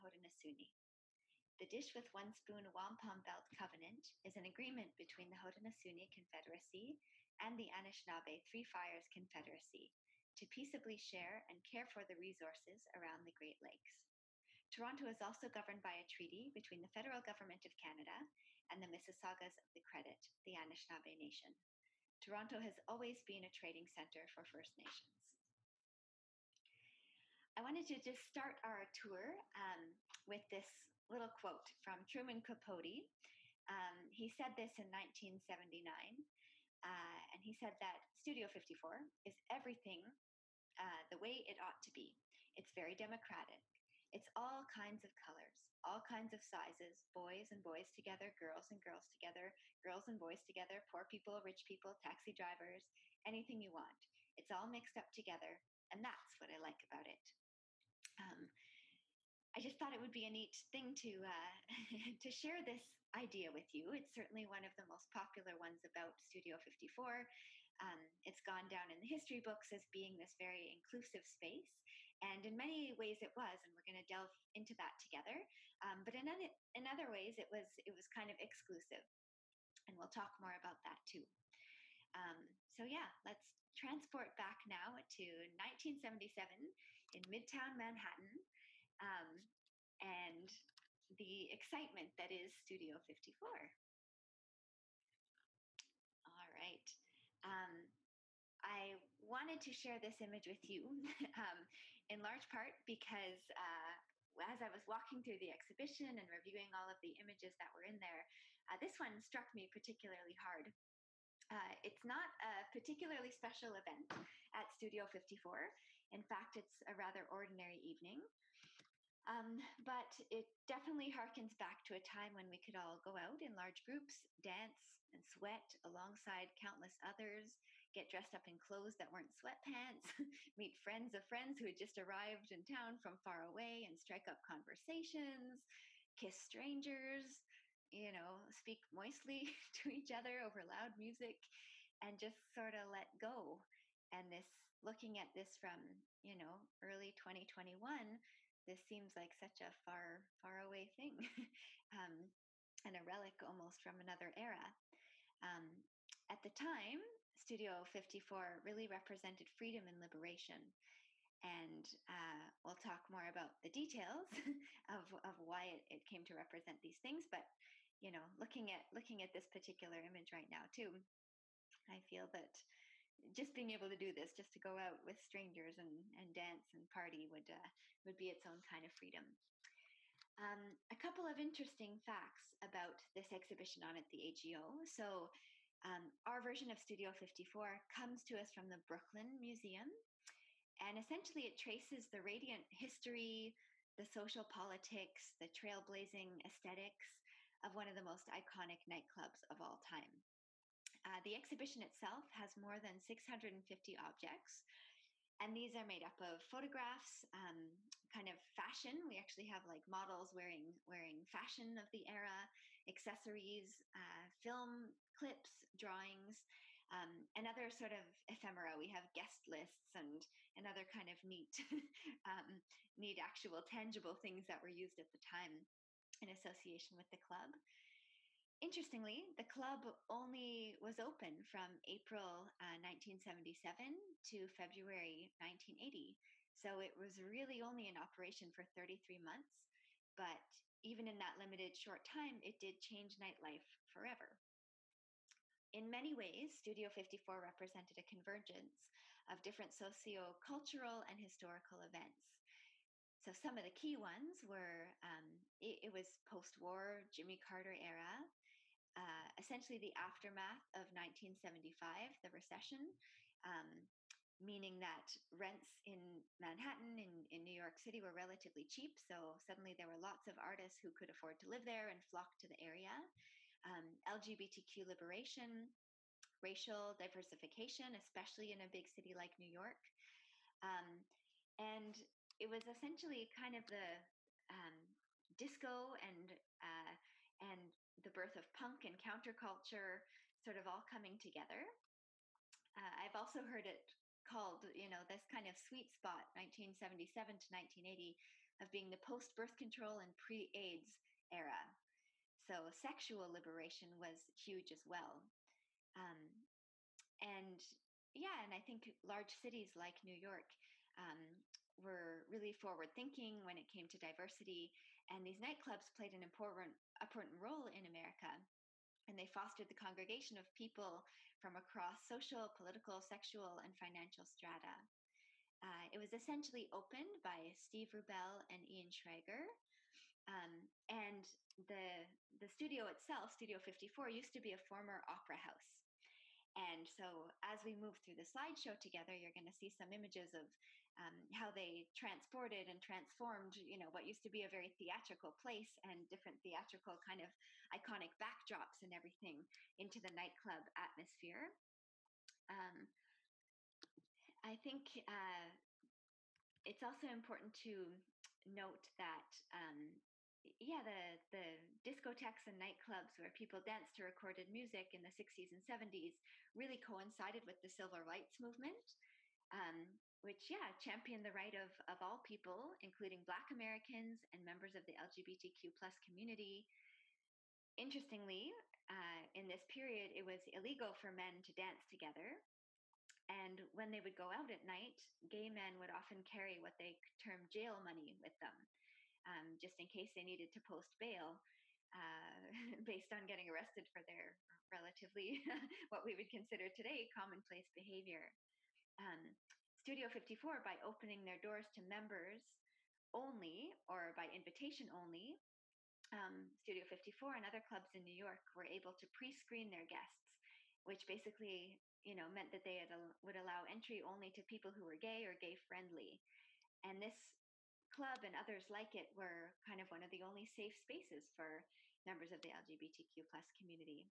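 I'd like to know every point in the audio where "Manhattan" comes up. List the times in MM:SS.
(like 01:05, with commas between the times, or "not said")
01:27, 04:26.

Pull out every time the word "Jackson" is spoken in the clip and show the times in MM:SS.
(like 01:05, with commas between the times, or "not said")
not said.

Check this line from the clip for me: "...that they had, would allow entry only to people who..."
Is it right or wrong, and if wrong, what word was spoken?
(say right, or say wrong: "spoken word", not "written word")
right.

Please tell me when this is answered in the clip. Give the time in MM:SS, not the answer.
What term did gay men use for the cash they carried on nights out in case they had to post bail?
06:27.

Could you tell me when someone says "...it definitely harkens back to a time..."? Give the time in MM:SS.
02:00.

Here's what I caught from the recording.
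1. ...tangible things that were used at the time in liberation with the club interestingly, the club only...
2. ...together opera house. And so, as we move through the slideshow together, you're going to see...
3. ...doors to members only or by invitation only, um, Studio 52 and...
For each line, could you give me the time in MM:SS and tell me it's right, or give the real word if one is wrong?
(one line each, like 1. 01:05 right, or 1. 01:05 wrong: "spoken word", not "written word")
1. 03:43 wrong: "association", not "liberation"
2. 05:34 wrong: "former", not "together"
3. 06:41 wrong: "54", not "52".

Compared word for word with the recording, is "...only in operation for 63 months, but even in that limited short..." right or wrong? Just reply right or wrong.
wrong.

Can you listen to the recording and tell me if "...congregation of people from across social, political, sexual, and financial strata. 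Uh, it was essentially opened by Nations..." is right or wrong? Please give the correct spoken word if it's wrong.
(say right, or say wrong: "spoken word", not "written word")
wrong: "Steve", not "Nations".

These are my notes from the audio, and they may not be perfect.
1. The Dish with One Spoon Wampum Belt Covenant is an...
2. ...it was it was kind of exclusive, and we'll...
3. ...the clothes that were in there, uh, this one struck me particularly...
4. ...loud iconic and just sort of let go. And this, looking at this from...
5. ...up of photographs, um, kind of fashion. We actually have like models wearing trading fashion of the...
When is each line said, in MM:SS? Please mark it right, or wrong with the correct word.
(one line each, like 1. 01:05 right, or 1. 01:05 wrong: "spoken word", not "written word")
1. 00:01 right
2. 01:17 right
3. 01:47 wrong: "images", not "clothes"
4. 02:20 wrong: "music", not "iconic"
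5. 03:26 wrong: "wearing", not "trading".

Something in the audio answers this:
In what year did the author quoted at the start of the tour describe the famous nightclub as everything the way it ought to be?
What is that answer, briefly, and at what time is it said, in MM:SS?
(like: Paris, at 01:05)
1979, at 00:34.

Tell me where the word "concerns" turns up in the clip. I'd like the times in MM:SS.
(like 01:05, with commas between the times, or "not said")
not said.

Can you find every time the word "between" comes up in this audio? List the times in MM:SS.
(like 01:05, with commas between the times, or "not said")
00:04, 00:16.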